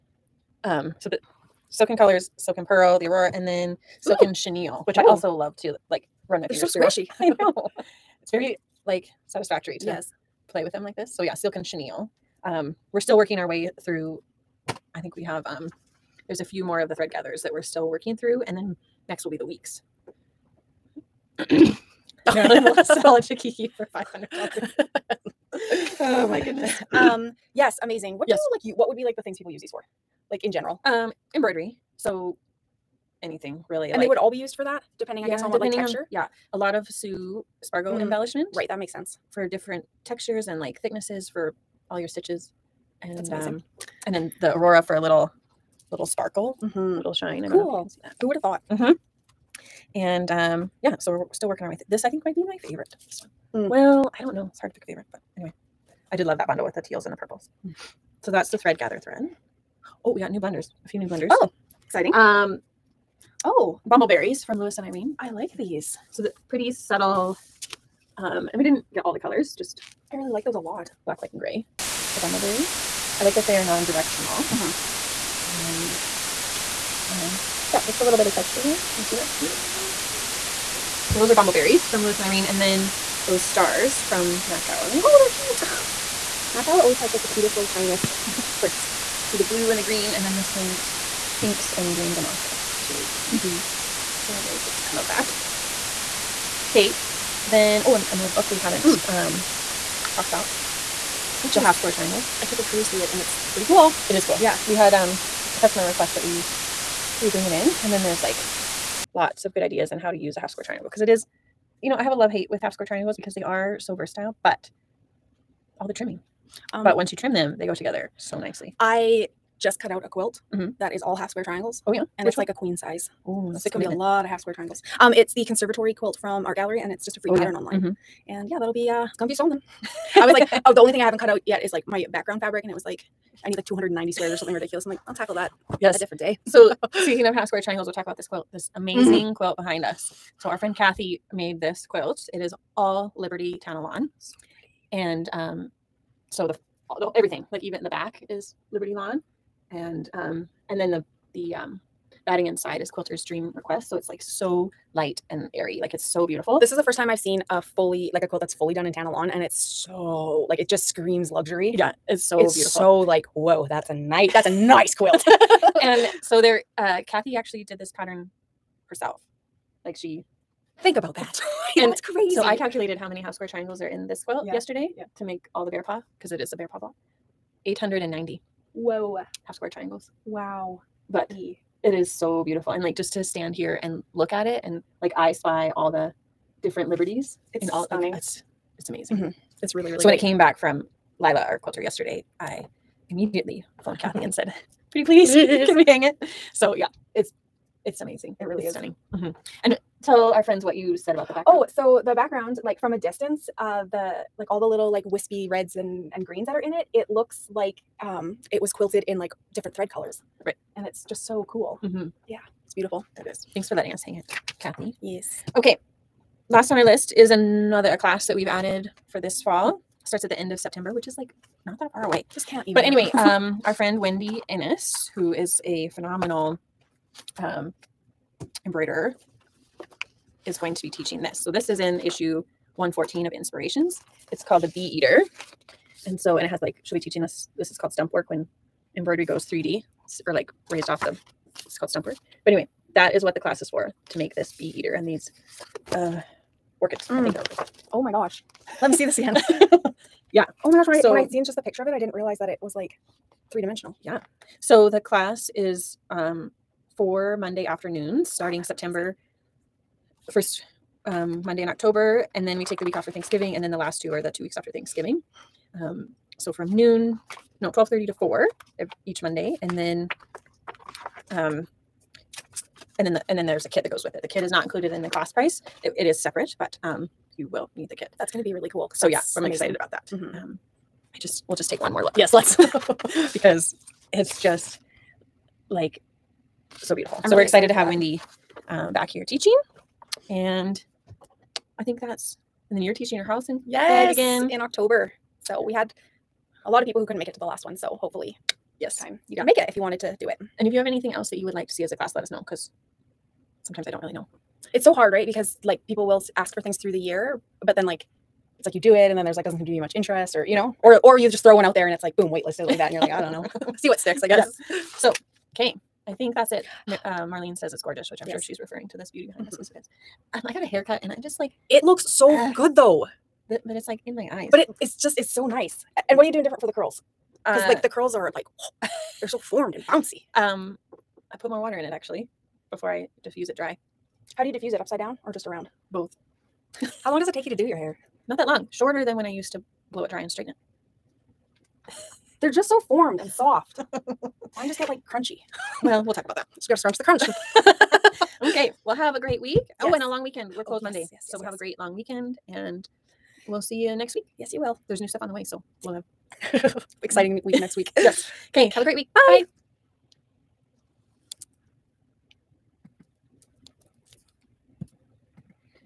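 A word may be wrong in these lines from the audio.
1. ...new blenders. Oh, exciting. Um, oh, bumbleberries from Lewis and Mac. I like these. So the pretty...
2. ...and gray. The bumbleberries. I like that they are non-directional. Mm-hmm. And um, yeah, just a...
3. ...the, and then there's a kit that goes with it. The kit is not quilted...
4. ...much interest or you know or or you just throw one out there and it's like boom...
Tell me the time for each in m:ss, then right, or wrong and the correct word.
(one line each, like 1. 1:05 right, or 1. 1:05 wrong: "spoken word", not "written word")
1. 1:00 wrong: "Irene", not "Mac"
2. 1:11 right
3. 4:33 wrong: "included", not "quilted"
4. 5:09 right.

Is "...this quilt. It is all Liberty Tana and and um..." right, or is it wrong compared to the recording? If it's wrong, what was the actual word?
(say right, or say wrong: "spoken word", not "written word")
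right.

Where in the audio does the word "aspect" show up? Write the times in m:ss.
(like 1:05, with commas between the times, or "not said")
not said.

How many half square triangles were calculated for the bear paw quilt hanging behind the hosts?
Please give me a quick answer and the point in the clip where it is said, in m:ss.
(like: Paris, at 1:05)
890, at 2:57.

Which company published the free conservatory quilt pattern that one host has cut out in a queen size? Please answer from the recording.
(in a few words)
Art Gallery.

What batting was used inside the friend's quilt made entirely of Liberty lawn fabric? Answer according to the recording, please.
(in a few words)
Quilter's Dream Request.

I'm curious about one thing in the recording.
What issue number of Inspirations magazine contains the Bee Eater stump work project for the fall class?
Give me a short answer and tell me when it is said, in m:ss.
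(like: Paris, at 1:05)
114, at 3:52.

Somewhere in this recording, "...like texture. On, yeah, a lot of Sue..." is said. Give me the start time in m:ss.
0:35.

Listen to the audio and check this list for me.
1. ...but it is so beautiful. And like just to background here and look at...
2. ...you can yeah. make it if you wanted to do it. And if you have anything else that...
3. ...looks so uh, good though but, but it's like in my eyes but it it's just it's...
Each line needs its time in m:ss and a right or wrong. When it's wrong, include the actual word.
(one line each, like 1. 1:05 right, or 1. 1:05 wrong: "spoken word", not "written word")
1. 3:01 wrong: "stand", not "background"
2. 4:59 right
3. 5:21 right.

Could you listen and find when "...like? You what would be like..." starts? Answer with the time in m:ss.
0:28.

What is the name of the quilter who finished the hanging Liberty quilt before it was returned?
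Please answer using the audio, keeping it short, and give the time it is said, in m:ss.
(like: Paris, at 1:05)
Lila, at 3:11.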